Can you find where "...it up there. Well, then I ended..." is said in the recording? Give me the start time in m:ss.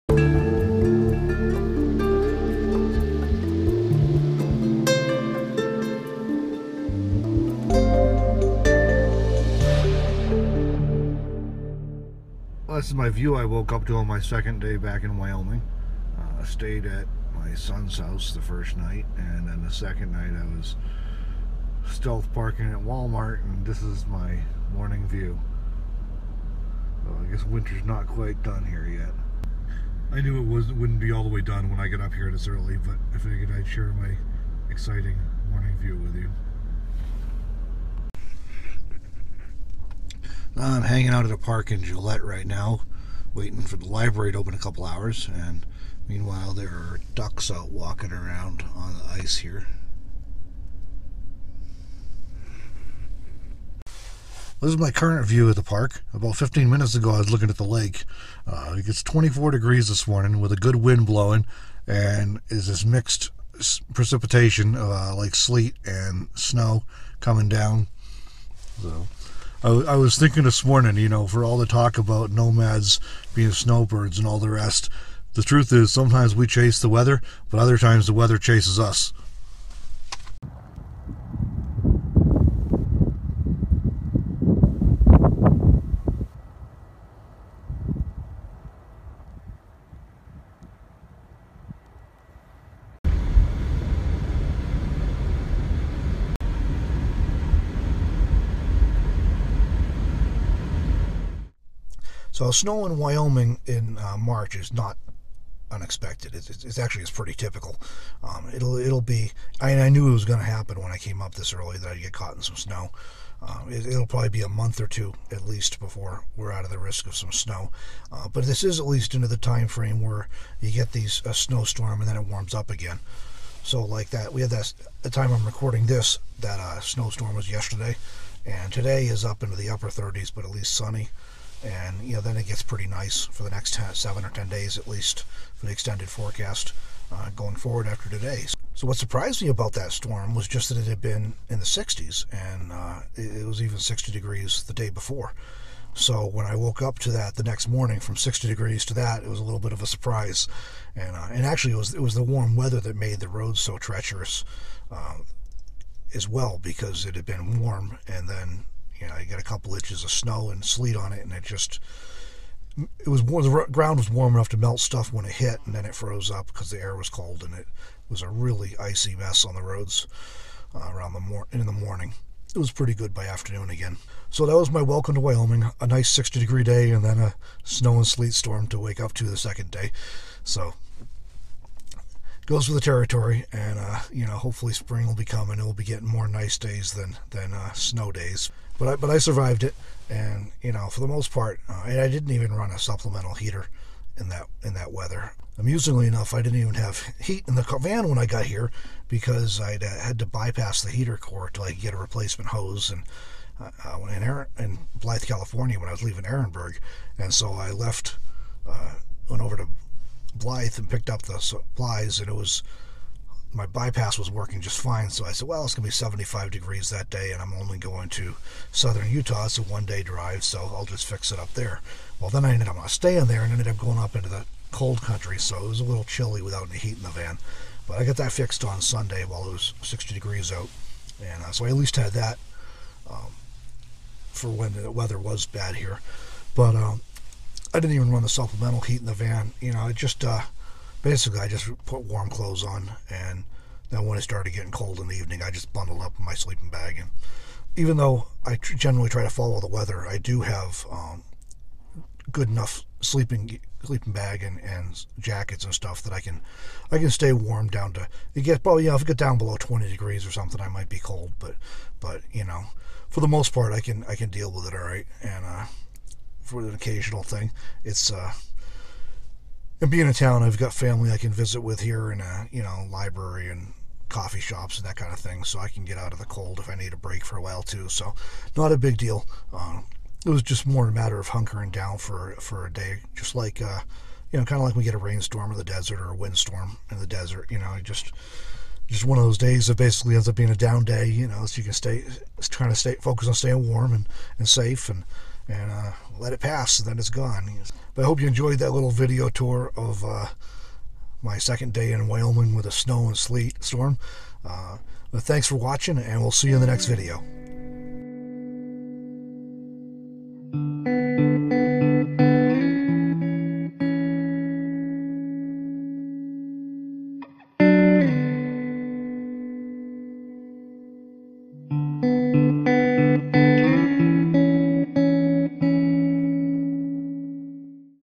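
3:41.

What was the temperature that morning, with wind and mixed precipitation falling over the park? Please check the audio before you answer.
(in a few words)
24 degrees.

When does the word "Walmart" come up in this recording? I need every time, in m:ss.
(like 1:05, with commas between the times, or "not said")
0:22.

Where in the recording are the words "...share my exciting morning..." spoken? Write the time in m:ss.
0:33.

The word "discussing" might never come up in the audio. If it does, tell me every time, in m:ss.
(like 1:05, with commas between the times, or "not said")
not said.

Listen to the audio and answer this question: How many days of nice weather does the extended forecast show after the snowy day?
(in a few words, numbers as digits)
7 or 10.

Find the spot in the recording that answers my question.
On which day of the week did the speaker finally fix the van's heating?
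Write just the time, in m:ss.
3:48.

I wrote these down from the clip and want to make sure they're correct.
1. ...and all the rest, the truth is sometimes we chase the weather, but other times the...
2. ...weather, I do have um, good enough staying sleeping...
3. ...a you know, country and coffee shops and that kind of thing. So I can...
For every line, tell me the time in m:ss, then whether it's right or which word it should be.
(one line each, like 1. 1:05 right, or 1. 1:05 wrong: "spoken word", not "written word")
1. 1:14 right
2. 4:09 wrong: "sleeping", not "staying"
3. 4:32 wrong: "library", not "country".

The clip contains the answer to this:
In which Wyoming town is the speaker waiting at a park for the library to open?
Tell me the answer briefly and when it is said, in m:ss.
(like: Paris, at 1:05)
Gillette, at 0:41.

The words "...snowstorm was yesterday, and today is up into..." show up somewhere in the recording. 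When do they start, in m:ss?
2:06.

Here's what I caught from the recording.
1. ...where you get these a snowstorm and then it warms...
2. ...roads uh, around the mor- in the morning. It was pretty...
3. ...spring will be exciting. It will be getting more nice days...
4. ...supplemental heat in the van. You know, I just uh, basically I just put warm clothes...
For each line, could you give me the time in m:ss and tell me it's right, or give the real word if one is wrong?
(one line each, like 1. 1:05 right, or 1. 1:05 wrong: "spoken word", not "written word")
1. 2:00 right
2. 2:49 right
3. 3:04 wrong: "coming", not "exciting"
4. 3:58 right.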